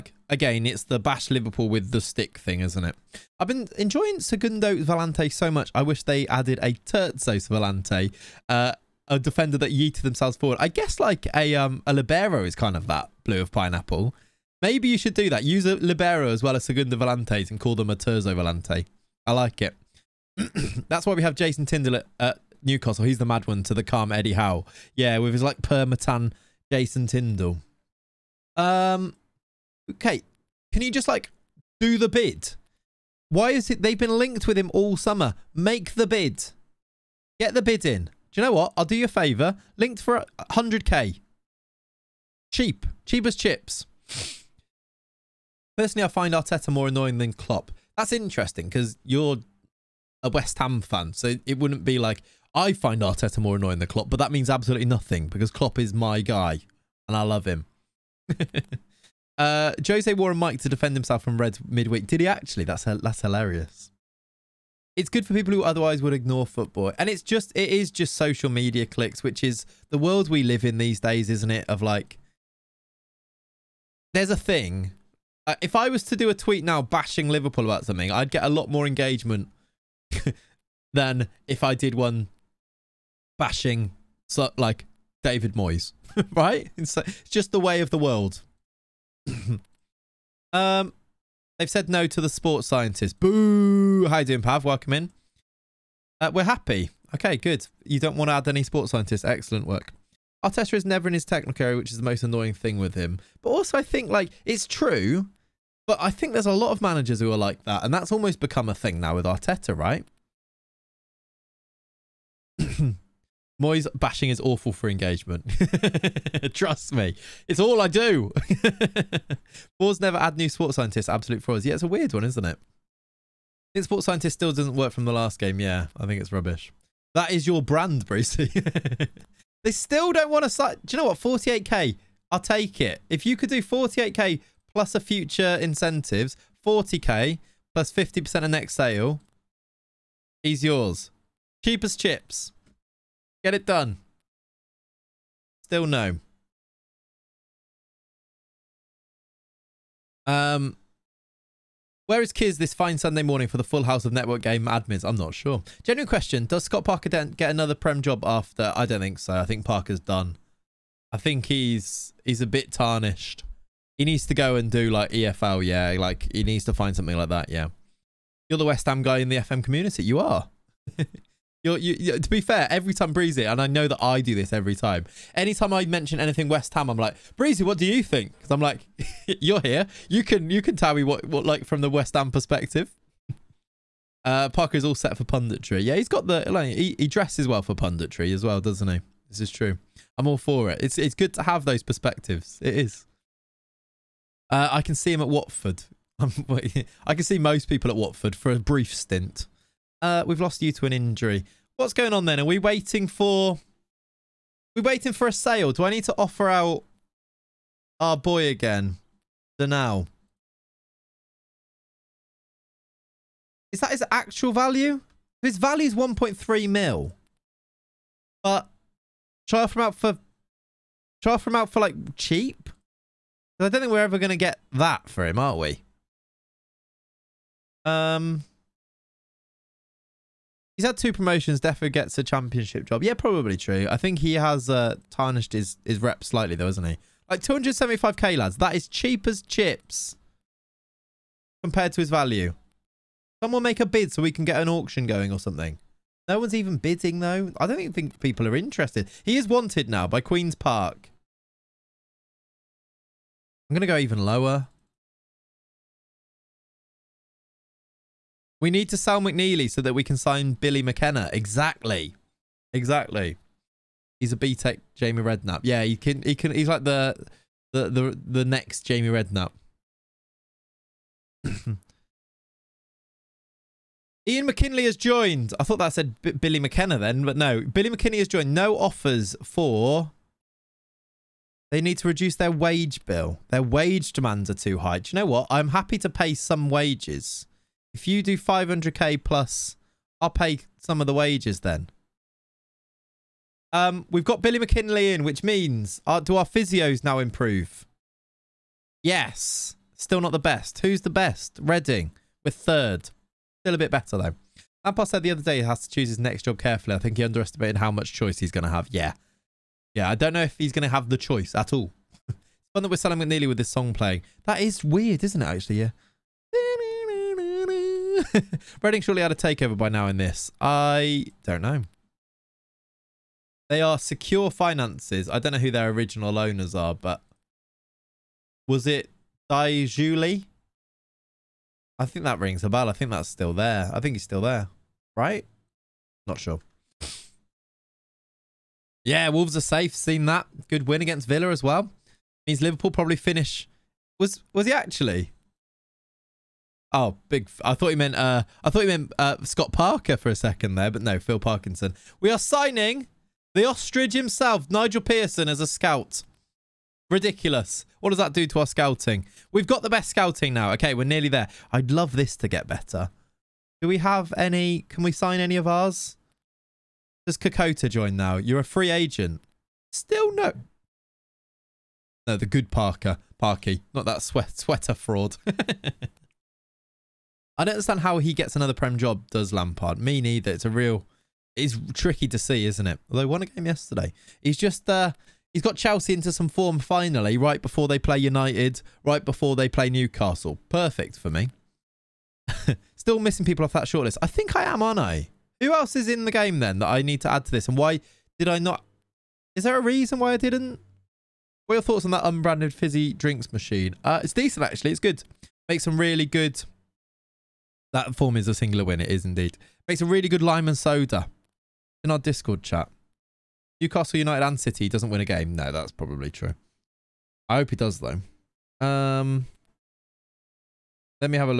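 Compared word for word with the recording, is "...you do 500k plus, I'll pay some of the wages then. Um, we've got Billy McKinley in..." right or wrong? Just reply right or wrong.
right.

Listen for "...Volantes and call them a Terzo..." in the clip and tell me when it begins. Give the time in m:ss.
0:16.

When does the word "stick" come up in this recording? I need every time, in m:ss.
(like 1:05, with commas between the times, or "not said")
0:01.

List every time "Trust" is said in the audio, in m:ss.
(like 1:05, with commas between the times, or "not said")
1:56.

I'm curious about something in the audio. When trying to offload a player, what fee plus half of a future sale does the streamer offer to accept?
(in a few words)
40k.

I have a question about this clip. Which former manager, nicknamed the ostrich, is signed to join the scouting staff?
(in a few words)
Nigel Pearson.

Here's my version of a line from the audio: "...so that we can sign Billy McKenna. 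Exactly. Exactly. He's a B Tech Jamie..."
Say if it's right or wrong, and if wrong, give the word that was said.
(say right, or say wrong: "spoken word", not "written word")
right.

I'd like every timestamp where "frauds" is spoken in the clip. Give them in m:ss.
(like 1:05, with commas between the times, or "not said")
2:01, 6:14.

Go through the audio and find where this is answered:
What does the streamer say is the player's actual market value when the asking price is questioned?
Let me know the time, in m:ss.
3:35.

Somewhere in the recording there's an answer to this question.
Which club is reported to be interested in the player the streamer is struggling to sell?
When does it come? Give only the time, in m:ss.
4:10.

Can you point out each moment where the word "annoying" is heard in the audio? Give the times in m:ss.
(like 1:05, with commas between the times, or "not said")
0:46, 0:53, 1:42.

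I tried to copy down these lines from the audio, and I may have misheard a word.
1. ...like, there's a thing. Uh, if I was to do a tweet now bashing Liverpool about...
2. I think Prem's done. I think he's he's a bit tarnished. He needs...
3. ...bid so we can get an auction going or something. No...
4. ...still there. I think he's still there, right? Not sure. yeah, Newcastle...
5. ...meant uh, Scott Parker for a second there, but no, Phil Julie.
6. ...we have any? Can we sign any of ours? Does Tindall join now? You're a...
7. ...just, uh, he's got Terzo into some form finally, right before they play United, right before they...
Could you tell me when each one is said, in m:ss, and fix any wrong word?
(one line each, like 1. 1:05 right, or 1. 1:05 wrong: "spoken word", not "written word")
1. 1:11 right
2. 2:39 wrong: "Parker", not "Prem"
3. 4:03 right
4. 5:33 wrong: "Wolves", not "Newcastle"
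5. 5:48 wrong: "Parkinson", not "Julie"
6. 6:03 wrong: "Kokota", not "Tindall"
7. 6:24 wrong: "Chelsea", not "Terzo".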